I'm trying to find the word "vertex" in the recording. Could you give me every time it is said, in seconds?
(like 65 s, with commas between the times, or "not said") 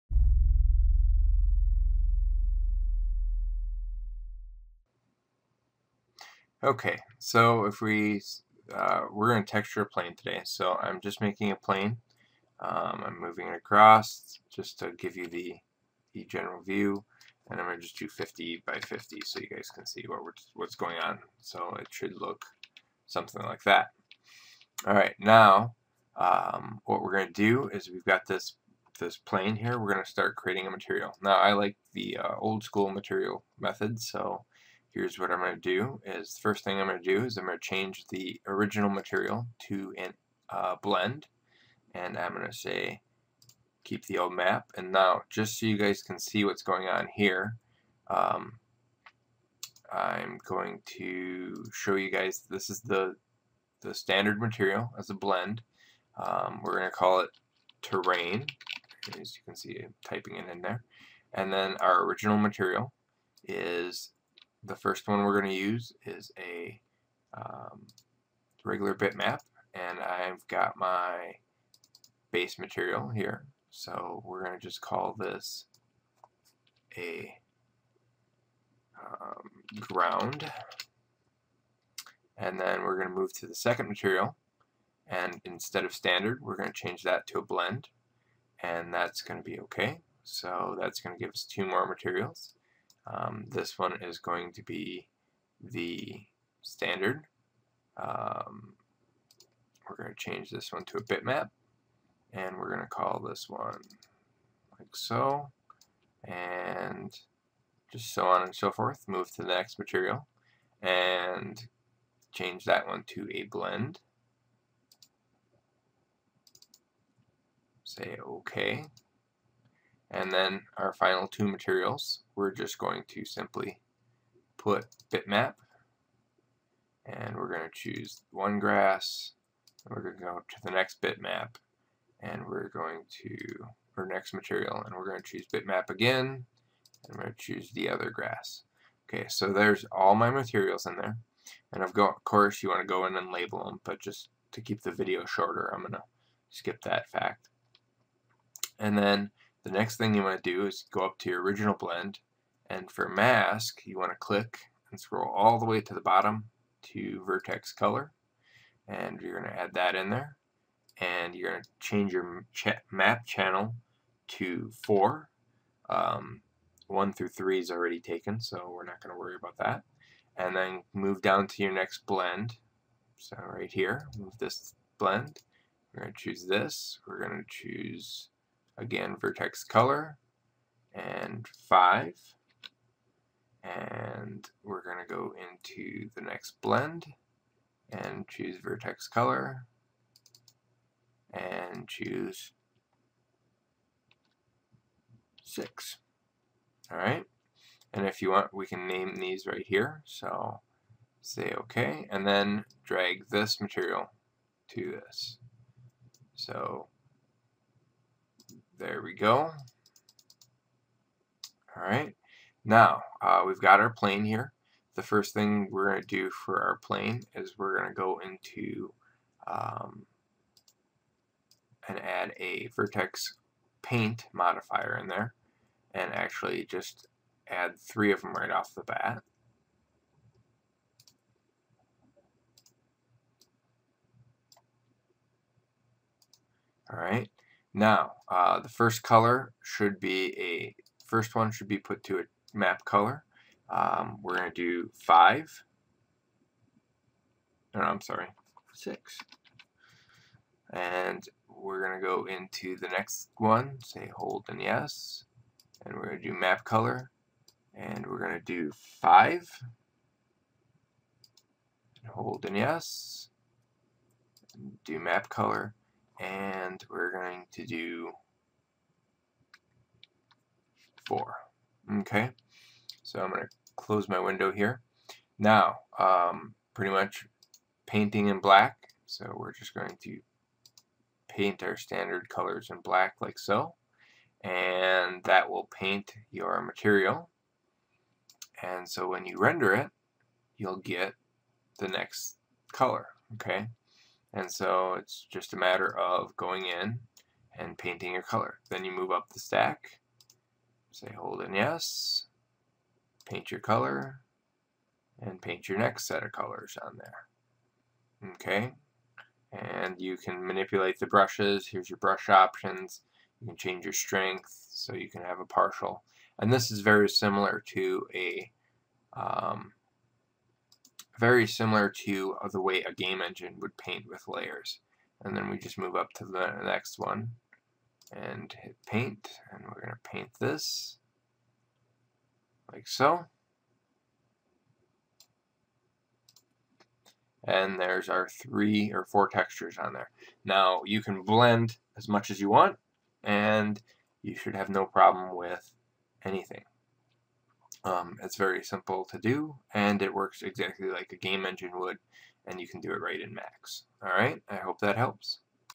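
157 s, 179 s, 188 s, 222 s.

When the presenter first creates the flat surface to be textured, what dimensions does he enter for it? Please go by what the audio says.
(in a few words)
50 by 50.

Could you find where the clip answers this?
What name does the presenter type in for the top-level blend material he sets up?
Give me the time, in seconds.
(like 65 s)
57 s.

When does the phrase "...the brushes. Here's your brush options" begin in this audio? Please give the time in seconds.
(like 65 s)
310 s.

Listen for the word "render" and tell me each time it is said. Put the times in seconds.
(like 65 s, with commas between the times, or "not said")
289 s.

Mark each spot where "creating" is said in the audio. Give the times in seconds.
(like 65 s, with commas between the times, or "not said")
30 s.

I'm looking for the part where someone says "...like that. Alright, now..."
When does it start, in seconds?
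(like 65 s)
23 s.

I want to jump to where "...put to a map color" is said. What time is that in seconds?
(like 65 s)
241 s.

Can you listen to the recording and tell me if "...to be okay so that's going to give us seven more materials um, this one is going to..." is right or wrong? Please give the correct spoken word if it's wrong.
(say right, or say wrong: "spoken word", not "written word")
wrong: "two", not "seven".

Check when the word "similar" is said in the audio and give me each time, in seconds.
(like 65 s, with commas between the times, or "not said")
317 s, 321 s.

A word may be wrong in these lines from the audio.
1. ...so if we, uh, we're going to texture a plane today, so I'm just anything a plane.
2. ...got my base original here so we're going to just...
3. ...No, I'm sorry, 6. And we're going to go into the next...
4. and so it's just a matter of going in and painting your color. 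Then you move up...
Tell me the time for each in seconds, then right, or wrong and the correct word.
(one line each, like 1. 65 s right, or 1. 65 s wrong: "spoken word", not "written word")
1. 7 s wrong: "making", not "anything"
2. 70 s wrong: "material", not "original"
3. 247 s right
4. 294 s right.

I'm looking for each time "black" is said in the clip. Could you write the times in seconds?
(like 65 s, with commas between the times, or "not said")
278 s, 282 s.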